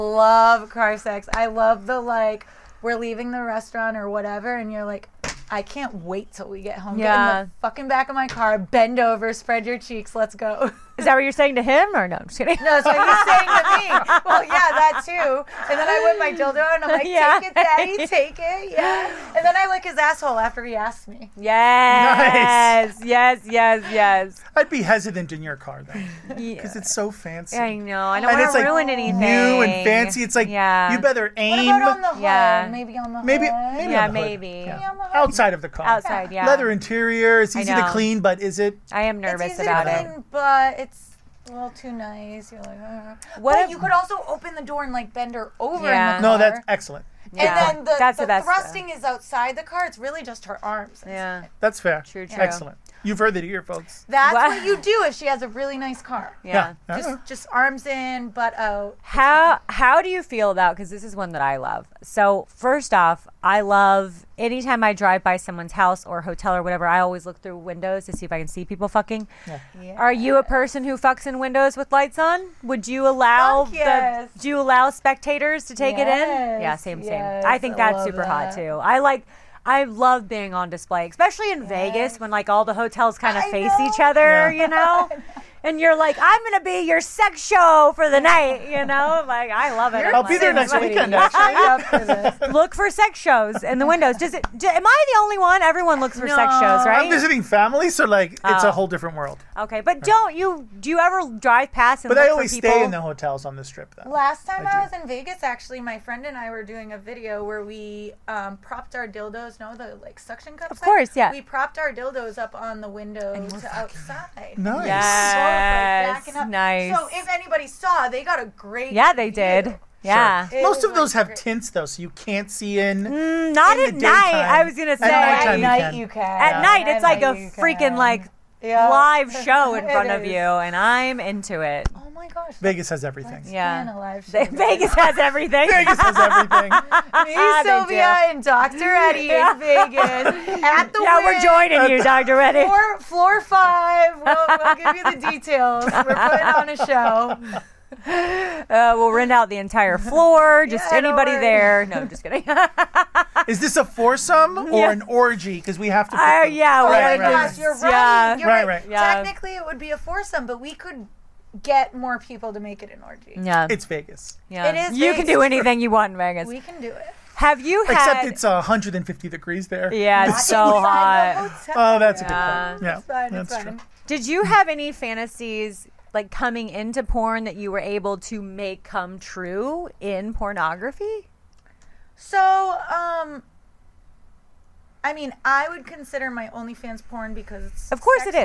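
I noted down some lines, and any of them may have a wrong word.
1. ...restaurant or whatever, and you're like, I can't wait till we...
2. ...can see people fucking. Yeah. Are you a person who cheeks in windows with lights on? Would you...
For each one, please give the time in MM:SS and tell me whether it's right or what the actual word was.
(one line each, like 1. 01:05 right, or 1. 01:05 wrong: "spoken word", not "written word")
1. 00:03 right
2. 01:08 wrong: "fucks", not "cheeks".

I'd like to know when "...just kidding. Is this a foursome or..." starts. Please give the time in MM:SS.
02:32.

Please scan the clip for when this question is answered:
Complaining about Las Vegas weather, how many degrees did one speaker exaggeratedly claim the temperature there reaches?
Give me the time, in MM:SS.
02:48.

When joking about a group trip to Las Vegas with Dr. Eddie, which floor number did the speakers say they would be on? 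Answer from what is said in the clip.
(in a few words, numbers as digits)
5.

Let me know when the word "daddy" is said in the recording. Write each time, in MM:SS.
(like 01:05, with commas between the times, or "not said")
00:17.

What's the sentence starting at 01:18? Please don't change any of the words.
I like I love being on display, especially in yes.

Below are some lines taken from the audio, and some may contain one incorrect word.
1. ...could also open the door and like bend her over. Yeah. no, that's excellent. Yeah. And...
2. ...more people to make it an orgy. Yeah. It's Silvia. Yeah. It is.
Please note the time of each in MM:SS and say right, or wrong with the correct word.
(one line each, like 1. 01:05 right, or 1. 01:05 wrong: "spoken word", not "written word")
1. 00:43 right
2. 02:41 wrong: "Vegas", not "Silvia".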